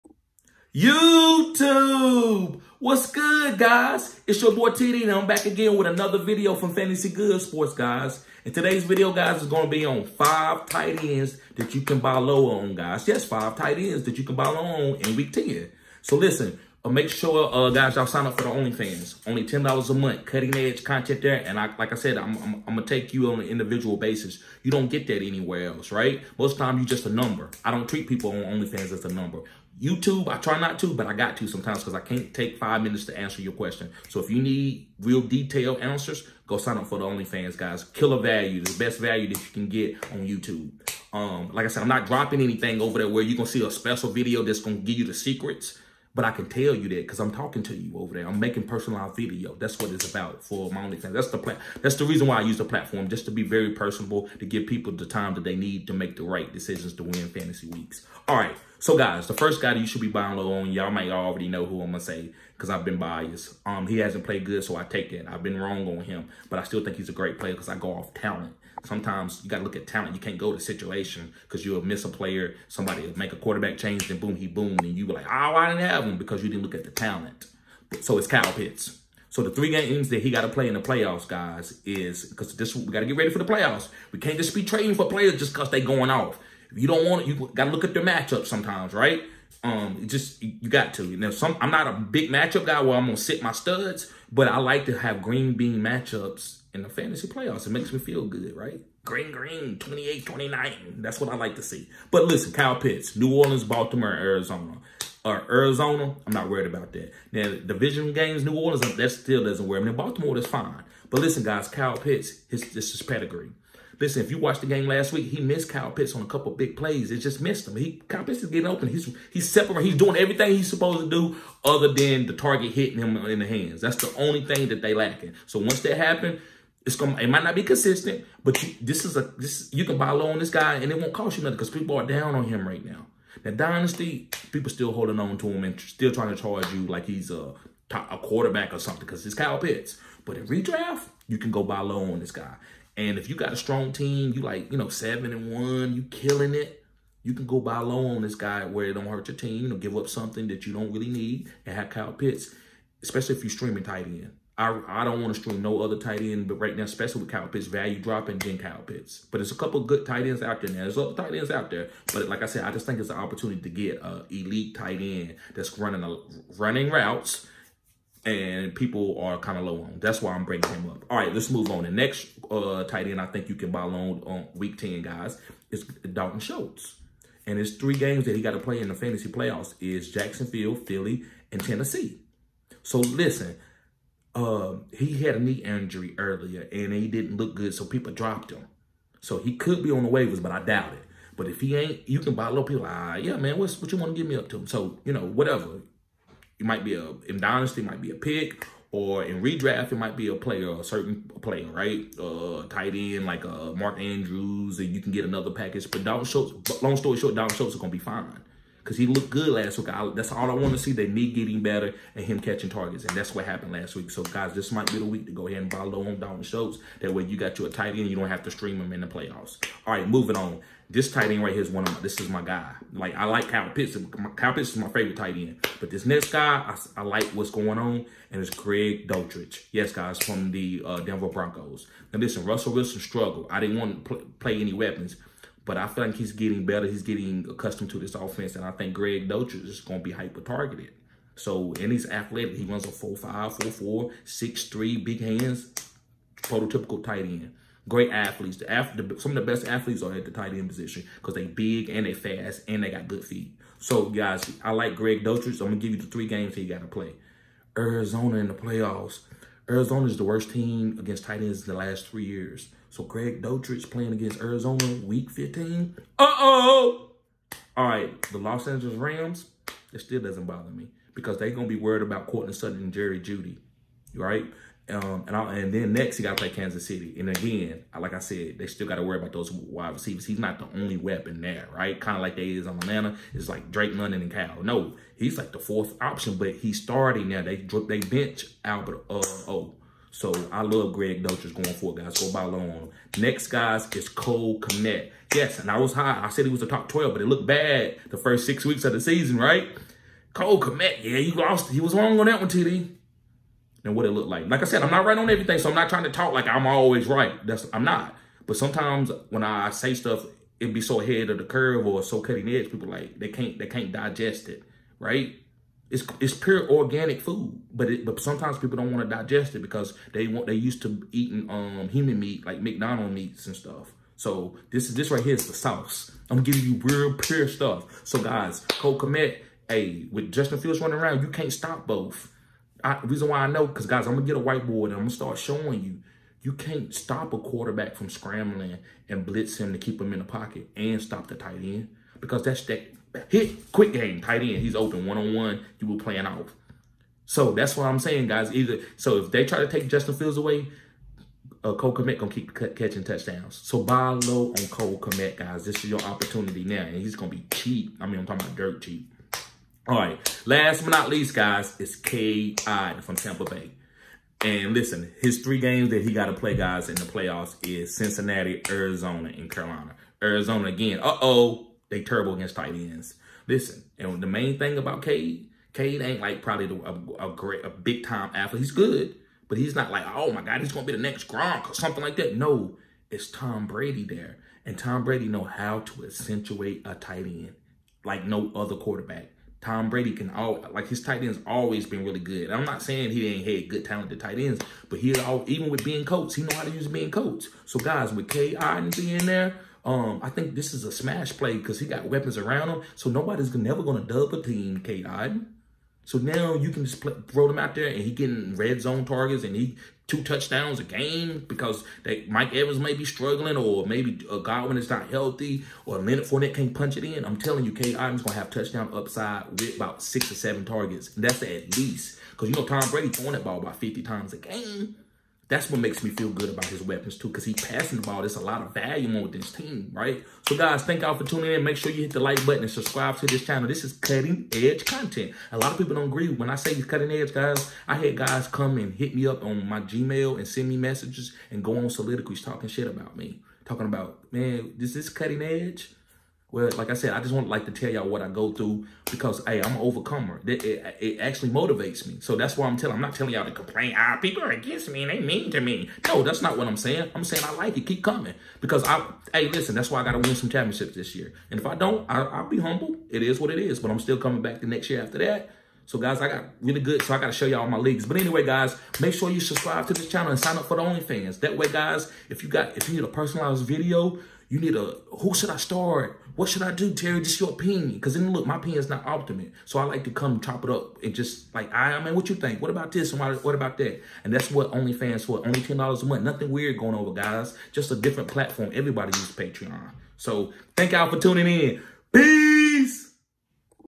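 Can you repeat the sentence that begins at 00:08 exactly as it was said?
And today's video, guys, is going to be on five tight ends that you can buy low on, guys.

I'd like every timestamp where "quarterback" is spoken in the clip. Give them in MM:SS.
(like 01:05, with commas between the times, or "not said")
01:13, 02:18, 05:37, 06:28.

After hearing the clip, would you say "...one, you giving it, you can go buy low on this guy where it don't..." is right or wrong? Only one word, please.
wrong.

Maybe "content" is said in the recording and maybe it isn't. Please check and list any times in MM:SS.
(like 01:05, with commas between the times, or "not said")
00:20, 07:14.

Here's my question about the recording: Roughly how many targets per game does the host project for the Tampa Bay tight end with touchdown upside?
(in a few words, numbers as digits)
6 or 7.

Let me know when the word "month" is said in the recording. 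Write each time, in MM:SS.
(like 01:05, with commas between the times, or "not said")
00:19, 08:06.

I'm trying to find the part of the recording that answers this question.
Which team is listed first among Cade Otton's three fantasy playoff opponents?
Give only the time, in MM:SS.
06:07.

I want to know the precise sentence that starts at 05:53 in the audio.
So buy low on Cole Kmet, guys.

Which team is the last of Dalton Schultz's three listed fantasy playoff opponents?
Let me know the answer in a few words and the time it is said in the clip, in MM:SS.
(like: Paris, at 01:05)
Tennessee, at 03:01.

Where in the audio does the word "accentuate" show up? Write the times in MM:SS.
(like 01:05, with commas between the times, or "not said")
06:26.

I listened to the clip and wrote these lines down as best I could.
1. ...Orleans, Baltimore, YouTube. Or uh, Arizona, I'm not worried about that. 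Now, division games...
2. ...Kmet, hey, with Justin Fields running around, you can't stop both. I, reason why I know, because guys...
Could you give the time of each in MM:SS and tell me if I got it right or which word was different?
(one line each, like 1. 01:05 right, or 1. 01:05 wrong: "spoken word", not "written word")
1. 01:43 wrong: "Arizona", not "YouTube"
2. 05:28 right.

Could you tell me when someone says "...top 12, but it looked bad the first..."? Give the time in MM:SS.
04:56.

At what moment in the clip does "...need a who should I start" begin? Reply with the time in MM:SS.
07:54.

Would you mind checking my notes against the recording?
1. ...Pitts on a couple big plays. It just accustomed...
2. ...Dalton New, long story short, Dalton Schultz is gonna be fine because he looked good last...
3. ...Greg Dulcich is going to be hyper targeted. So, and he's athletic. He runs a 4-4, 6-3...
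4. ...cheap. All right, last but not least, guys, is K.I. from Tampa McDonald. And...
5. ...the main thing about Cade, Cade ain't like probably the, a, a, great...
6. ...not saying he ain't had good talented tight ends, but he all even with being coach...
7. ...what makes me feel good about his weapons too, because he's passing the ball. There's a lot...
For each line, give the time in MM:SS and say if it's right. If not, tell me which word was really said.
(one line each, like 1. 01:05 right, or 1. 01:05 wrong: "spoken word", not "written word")
1. 01:55 wrong: "missed", not "accustomed"
2. 03:26 wrong: "Schultz", not "New"
3. 03:58 right
4. 05:58 wrong: "Bay", not "McDonald"
5. 06:14 right
6. 06:32 right
7. 07:05 right.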